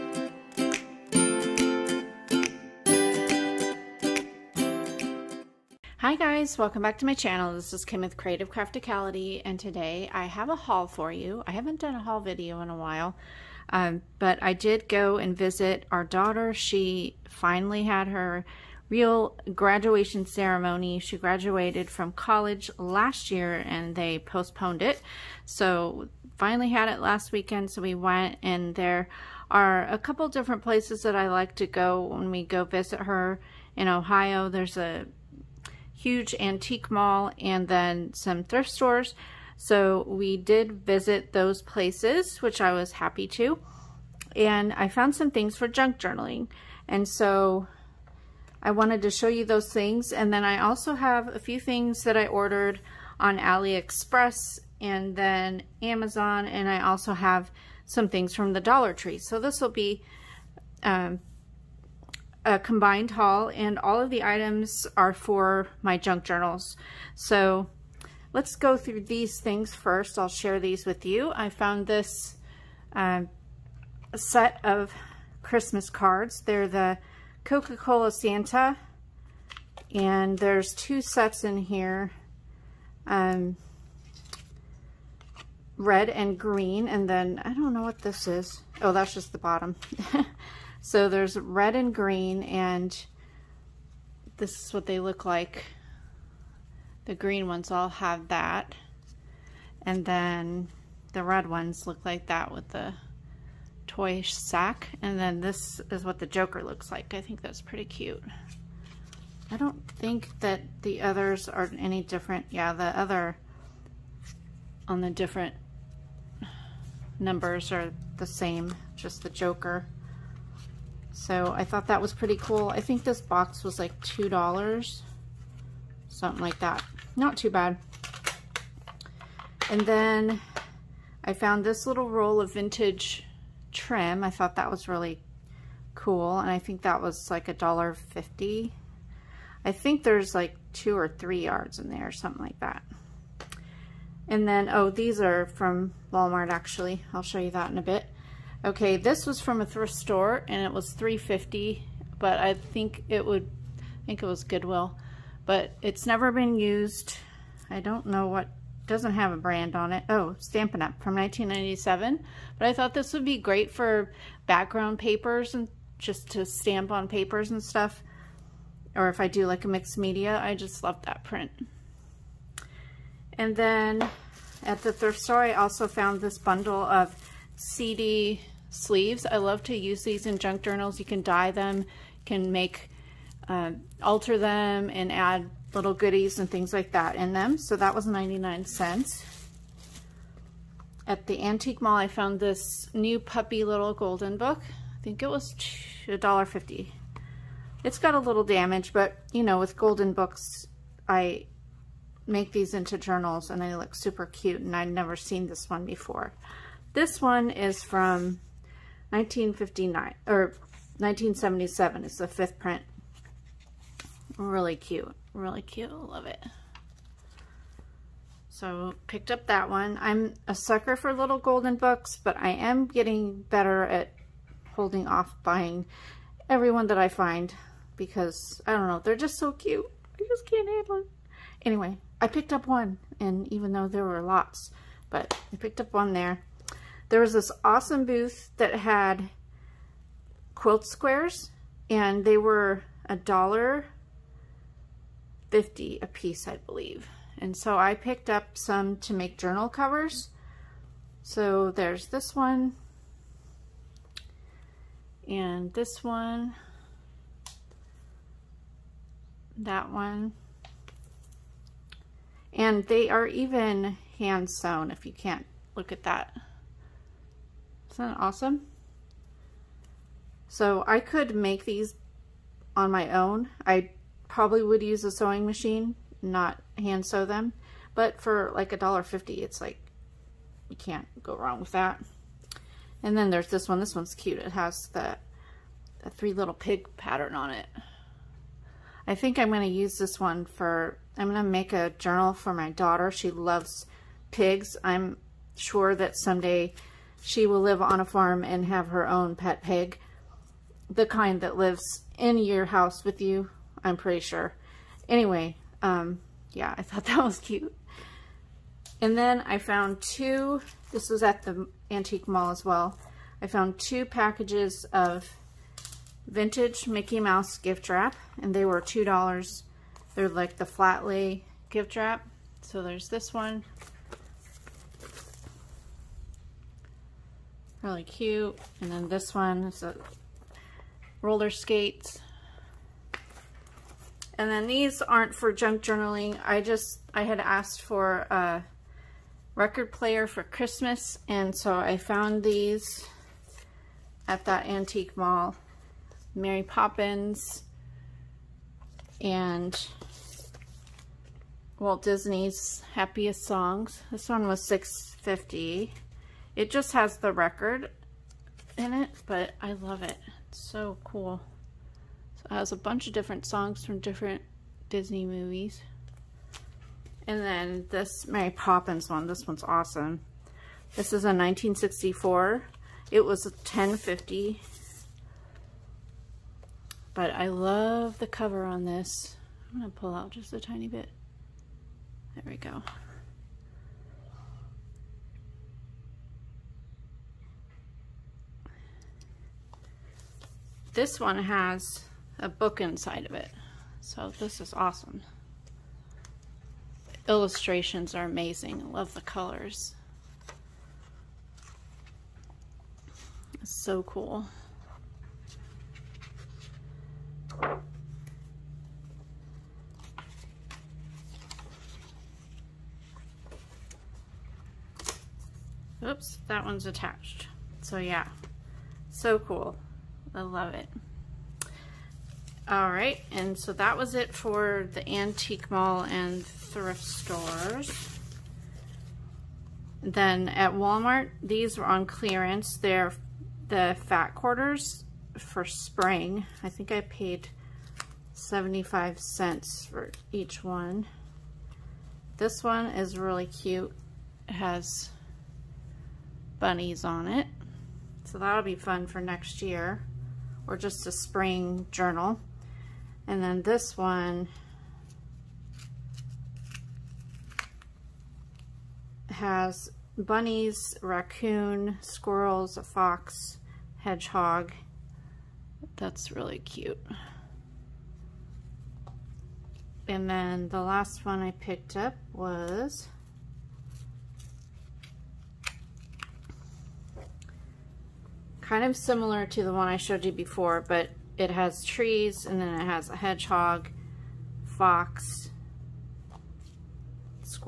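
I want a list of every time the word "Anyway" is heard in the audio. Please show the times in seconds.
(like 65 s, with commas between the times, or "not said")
231 s, 305 s.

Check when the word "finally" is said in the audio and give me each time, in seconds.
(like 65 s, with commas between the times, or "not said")
17 s, 26 s.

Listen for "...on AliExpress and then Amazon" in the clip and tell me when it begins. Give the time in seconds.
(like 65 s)
53 s.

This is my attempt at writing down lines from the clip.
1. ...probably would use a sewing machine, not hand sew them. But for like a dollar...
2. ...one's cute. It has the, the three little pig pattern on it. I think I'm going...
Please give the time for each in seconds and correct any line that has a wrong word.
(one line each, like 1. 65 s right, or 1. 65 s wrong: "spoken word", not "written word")
1. 274 s right
2. 283 s right.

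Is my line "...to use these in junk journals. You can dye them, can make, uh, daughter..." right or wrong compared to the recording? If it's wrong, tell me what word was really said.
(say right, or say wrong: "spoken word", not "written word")
wrong: "alter", not "daughter".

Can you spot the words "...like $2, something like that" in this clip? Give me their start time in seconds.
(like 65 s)
123 s.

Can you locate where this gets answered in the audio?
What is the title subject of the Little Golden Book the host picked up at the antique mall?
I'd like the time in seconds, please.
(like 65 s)
192 s.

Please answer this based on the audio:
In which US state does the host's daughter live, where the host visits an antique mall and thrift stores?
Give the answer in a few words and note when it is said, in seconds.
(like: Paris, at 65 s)
Ohio, at 33 s.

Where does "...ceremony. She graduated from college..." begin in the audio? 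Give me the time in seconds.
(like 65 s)
20 s.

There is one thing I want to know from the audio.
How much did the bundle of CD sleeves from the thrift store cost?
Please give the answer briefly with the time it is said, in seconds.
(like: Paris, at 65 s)
99 cents, at 188 s.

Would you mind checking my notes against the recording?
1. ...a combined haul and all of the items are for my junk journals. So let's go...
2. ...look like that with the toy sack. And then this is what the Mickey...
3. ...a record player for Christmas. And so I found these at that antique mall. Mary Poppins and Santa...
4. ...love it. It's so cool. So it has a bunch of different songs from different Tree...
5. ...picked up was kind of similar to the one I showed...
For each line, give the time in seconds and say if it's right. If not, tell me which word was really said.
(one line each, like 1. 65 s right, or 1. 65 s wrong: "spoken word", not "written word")
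1. 62 s right
2. 101 s wrong: "Joker", not "Mickey"
3. 338 s wrong: "Walt", not "Santa"
4. 359 s wrong: "Disney", not "Tree"
5. 471 s right.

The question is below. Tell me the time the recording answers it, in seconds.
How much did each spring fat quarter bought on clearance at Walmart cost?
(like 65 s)
438 s.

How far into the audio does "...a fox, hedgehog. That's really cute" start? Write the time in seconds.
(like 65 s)
462 s.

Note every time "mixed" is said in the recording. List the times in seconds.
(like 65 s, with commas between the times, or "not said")
169 s.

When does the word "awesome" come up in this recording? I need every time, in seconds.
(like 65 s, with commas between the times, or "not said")
237 s, 268 s, 369 s, 394 s.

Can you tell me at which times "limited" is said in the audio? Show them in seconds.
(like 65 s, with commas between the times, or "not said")
not said.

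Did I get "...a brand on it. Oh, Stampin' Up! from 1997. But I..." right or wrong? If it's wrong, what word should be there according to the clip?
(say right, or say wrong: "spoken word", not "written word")
right.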